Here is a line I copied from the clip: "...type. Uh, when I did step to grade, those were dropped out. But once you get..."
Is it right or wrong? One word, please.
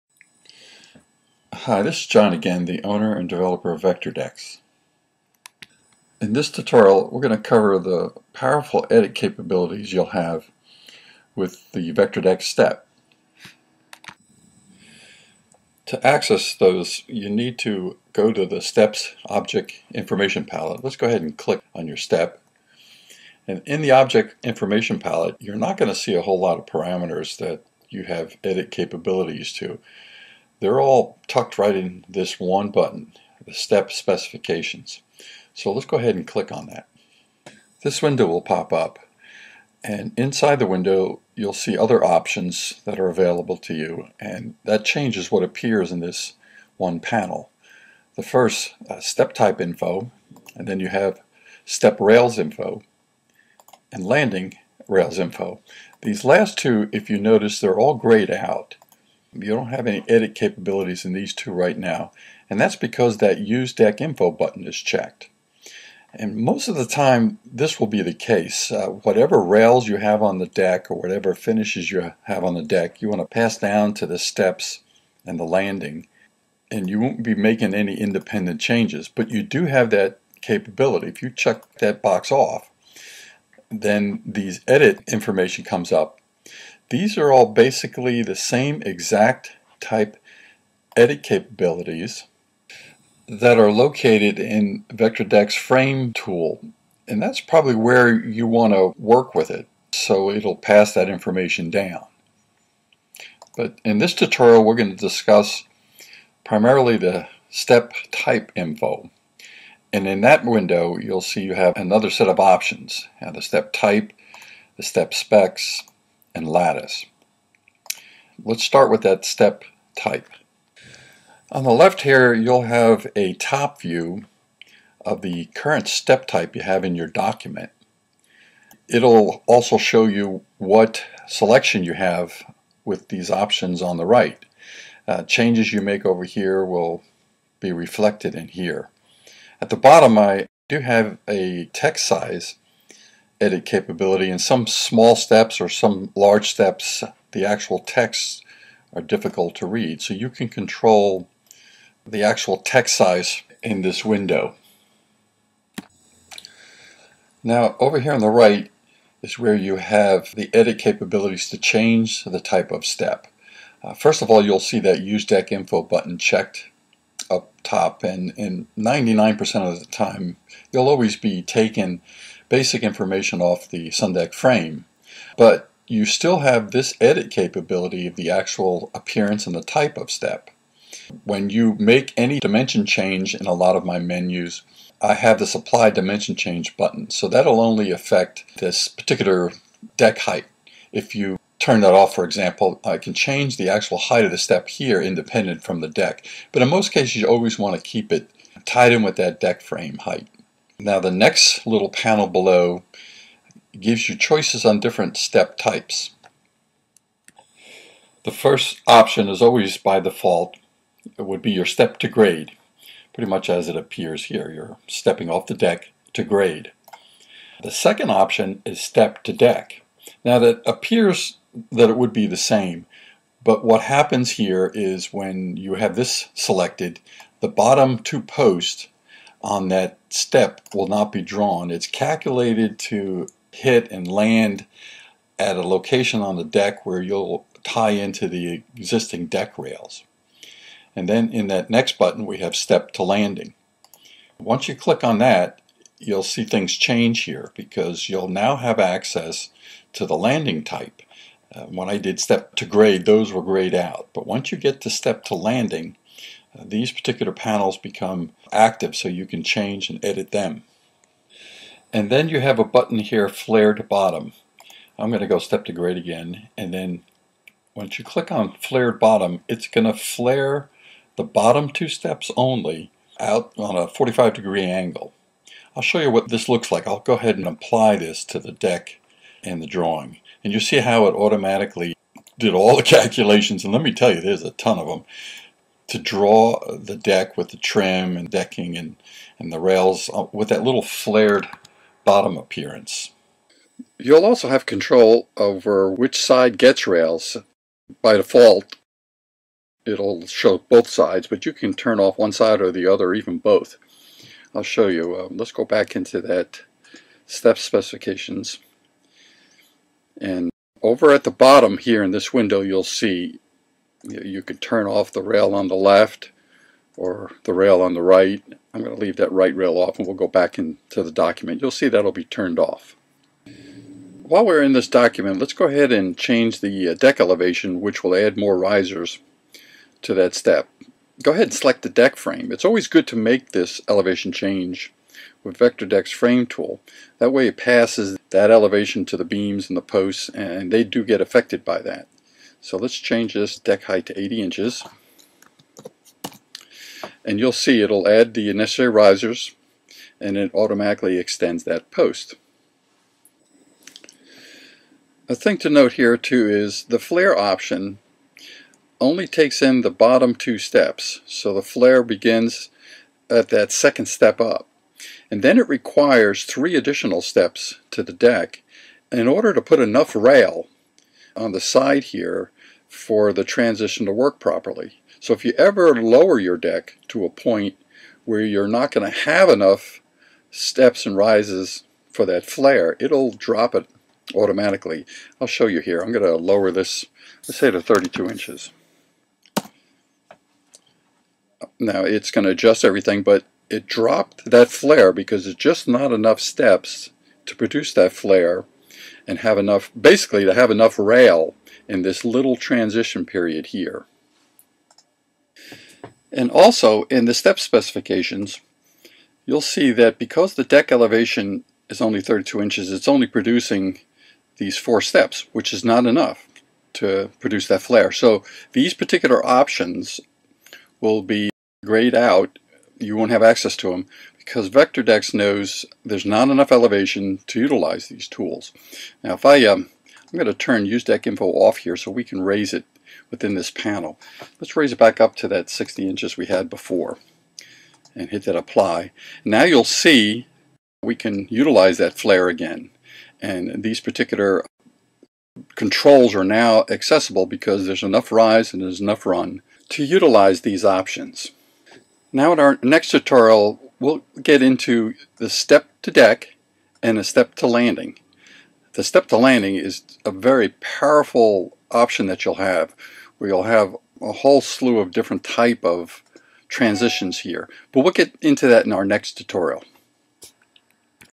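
wrong.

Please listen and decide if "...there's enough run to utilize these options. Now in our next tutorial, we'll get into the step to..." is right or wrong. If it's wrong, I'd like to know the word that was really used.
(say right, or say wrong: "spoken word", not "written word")
right.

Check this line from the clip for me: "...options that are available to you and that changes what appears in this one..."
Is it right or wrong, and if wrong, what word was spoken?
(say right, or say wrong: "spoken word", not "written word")
right.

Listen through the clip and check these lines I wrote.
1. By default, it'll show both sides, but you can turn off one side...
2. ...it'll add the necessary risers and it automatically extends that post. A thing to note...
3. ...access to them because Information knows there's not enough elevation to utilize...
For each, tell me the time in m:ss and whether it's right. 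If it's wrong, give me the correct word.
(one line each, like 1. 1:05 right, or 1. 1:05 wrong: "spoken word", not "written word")
1. 4:58 right
2. 5:47 right
3. 7:03 wrong: "VectorDecks", not "Information".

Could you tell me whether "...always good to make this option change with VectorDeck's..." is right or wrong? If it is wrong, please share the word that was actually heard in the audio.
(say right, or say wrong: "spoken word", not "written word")
wrong: "elevation", not "option".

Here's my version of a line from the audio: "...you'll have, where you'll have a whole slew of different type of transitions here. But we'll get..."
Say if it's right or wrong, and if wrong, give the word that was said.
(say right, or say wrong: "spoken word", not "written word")
right.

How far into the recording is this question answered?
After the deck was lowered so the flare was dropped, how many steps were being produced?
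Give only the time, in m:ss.
6:54.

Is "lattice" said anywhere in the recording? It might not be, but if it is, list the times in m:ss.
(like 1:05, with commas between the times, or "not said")
1:56.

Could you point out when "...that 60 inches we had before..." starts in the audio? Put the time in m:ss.
7:15.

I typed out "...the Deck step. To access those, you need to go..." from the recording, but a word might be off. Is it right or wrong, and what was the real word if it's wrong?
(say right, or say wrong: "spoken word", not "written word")
wrong: "VectorDecks", not "Deck".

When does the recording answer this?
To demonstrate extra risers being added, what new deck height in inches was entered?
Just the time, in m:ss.
5:44.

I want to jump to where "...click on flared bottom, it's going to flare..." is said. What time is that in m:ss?
4:28.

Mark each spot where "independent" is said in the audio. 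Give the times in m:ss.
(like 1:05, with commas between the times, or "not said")
1:17, 3:15.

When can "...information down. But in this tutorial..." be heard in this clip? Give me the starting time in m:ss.
1:41.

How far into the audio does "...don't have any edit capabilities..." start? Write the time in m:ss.
0:59.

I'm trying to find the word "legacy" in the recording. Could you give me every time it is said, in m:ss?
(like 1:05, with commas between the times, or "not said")
not said.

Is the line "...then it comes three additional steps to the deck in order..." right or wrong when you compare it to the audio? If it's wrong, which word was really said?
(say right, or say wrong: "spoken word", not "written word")
wrong: "requires", not "comes".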